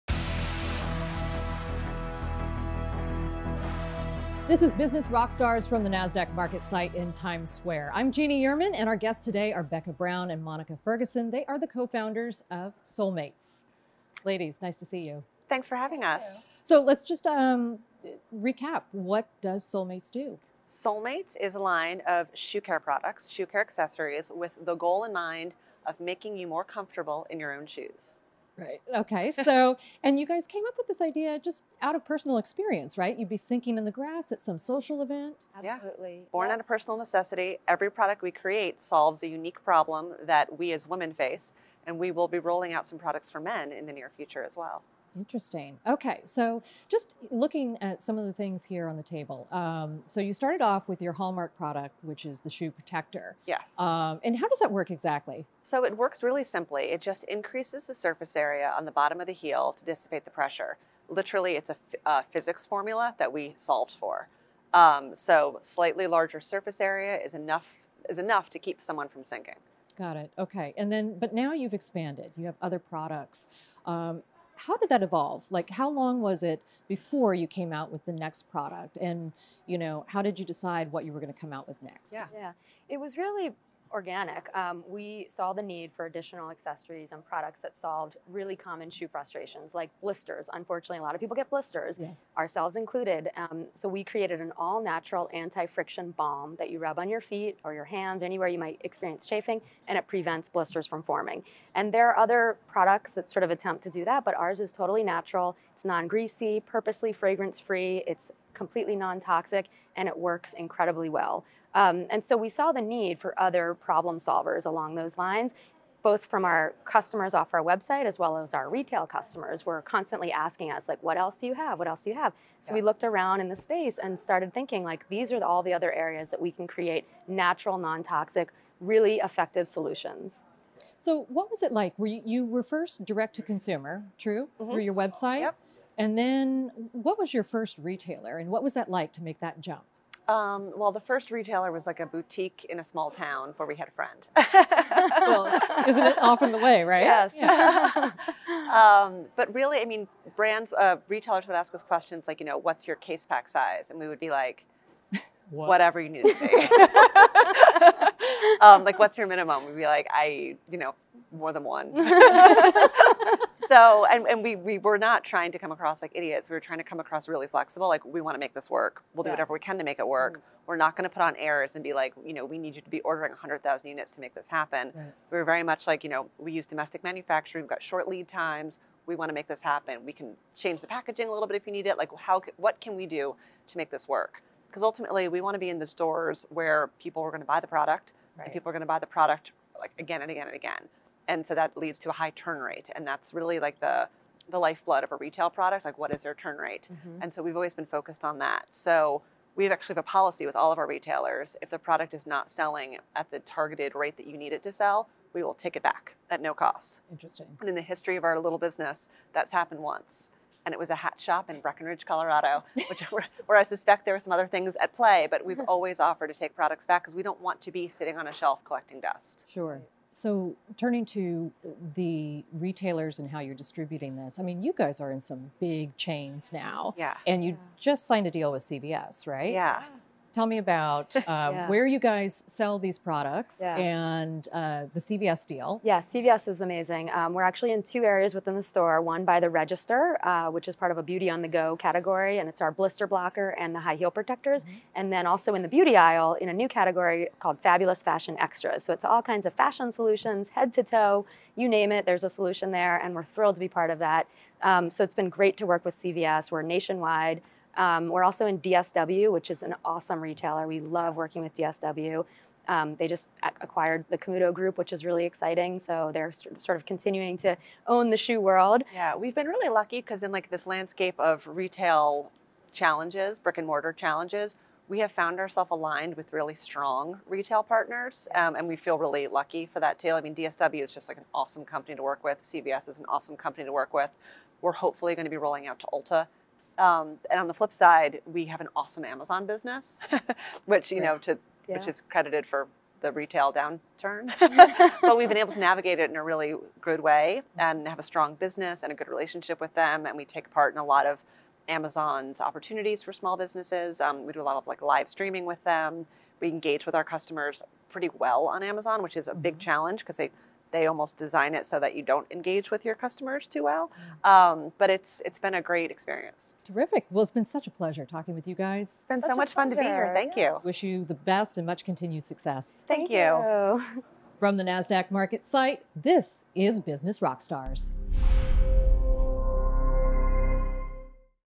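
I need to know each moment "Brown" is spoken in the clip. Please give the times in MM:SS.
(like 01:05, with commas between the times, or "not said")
00:09.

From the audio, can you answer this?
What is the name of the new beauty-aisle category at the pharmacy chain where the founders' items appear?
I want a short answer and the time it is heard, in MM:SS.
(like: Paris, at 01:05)
Fabulous Fashion Extras, at 04:07.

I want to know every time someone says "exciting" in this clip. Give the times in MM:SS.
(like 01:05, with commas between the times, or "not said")
04:25.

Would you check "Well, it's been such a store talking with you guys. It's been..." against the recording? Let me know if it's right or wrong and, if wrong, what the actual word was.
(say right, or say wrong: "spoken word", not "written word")
wrong: "pleasure", not "store".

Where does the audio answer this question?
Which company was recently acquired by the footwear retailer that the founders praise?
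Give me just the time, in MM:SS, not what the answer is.
04:24.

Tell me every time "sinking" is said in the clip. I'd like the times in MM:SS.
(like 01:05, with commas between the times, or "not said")
00:33, 01:09.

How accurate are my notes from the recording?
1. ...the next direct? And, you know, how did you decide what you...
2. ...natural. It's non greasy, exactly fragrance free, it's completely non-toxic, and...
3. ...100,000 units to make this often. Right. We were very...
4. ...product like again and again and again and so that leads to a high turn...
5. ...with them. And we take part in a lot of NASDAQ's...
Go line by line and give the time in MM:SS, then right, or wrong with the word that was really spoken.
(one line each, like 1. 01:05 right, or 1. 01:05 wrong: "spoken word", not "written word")
1. 01:18 wrong: "product", not "direct"
2. 01:45 wrong: "purposely", not "exactly"
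3. 02:53 wrong: "happen", not "often"
4. 03:09 right
5. 04:59 wrong: "Amazon", not "NASDAQ".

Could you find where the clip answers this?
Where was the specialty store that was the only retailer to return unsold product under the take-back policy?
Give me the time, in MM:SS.
03:31.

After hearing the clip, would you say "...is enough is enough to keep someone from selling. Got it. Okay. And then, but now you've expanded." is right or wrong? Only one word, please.
wrong.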